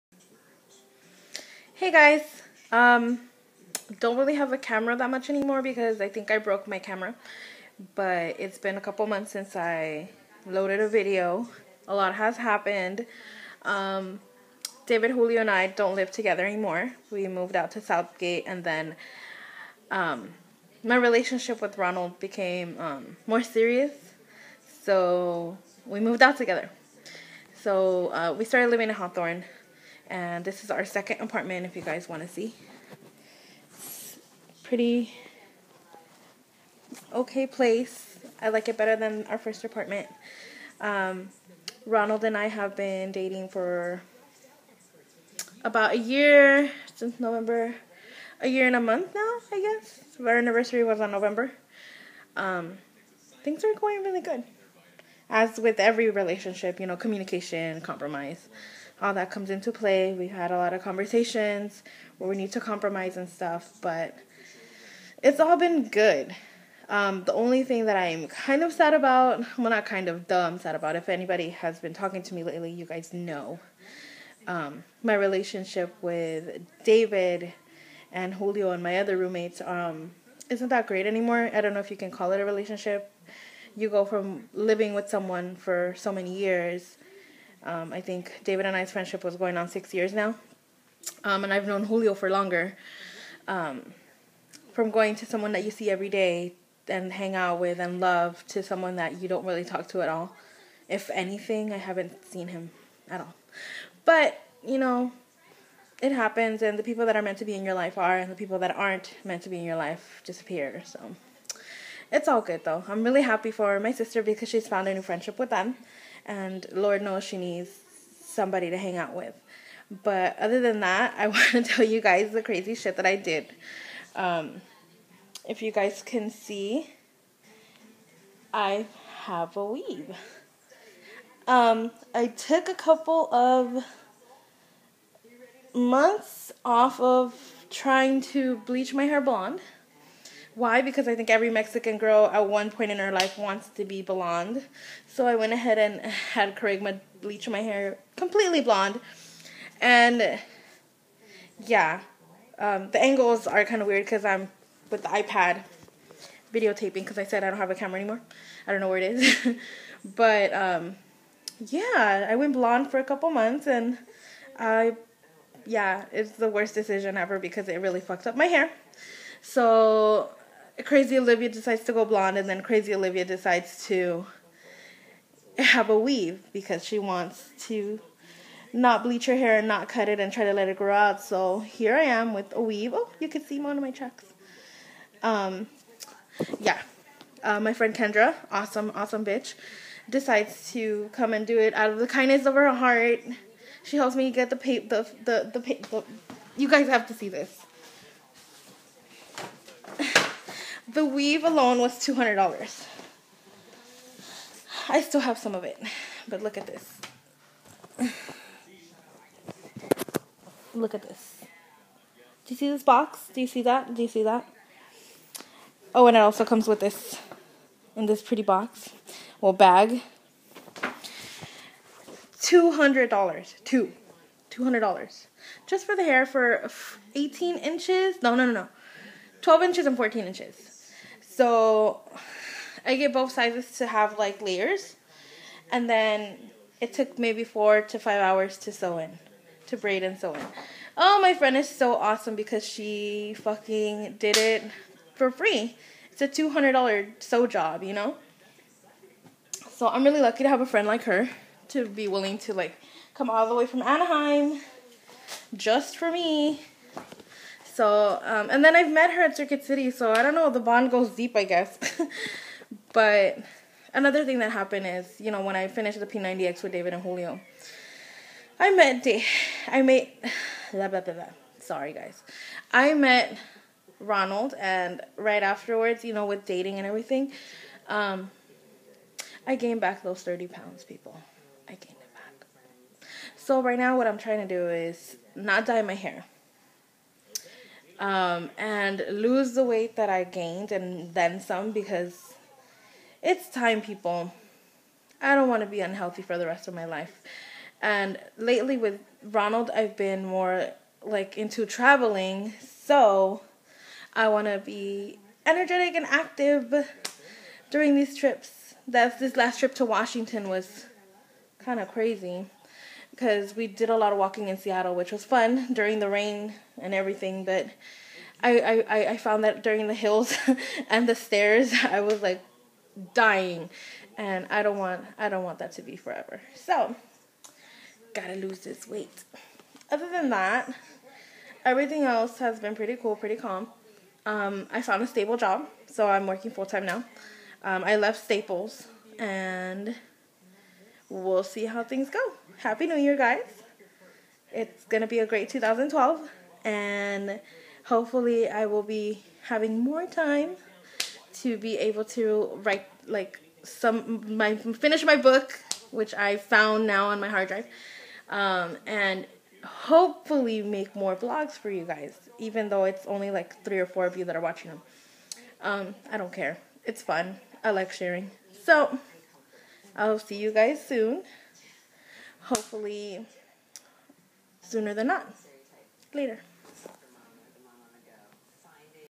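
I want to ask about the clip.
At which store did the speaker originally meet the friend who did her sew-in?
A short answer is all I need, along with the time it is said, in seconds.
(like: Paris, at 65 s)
Circuit City, at 259 s.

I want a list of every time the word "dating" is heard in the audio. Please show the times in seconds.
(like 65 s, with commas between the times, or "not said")
43 s, 276 s.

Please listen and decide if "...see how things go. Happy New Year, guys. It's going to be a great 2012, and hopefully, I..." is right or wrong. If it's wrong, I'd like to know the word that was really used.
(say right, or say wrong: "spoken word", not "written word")
right.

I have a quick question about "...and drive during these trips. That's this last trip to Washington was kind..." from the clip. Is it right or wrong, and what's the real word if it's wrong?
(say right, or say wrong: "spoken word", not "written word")
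wrong: "active", not "drive".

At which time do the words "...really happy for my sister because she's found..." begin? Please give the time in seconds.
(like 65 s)
113 s.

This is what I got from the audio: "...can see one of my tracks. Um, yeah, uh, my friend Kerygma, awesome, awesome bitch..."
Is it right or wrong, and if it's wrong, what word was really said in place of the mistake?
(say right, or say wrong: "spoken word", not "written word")
wrong: "Kendra", not "Kerygma".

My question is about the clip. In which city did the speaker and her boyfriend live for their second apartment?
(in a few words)
Hawthorne.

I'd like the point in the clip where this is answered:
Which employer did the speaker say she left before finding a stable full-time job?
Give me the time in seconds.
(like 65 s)
338 s.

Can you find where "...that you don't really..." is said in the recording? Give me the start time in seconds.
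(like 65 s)
98 s.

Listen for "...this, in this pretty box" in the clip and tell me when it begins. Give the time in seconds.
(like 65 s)
216 s.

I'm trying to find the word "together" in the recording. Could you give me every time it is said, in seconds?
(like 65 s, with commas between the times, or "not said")
16 s, 26 s.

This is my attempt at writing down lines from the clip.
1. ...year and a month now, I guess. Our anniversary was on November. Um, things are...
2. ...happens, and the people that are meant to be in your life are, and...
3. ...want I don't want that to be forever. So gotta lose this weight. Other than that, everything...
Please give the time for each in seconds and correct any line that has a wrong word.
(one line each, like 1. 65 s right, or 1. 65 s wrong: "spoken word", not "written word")
1. 48 s right
2. 106 s right
3. 324 s right.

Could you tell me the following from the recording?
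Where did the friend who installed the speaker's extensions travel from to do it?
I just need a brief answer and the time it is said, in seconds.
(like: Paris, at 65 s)
Anaheim, at 253 s.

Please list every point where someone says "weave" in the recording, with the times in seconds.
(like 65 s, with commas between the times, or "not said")
129 s, 175 s, 182 s, 201 s.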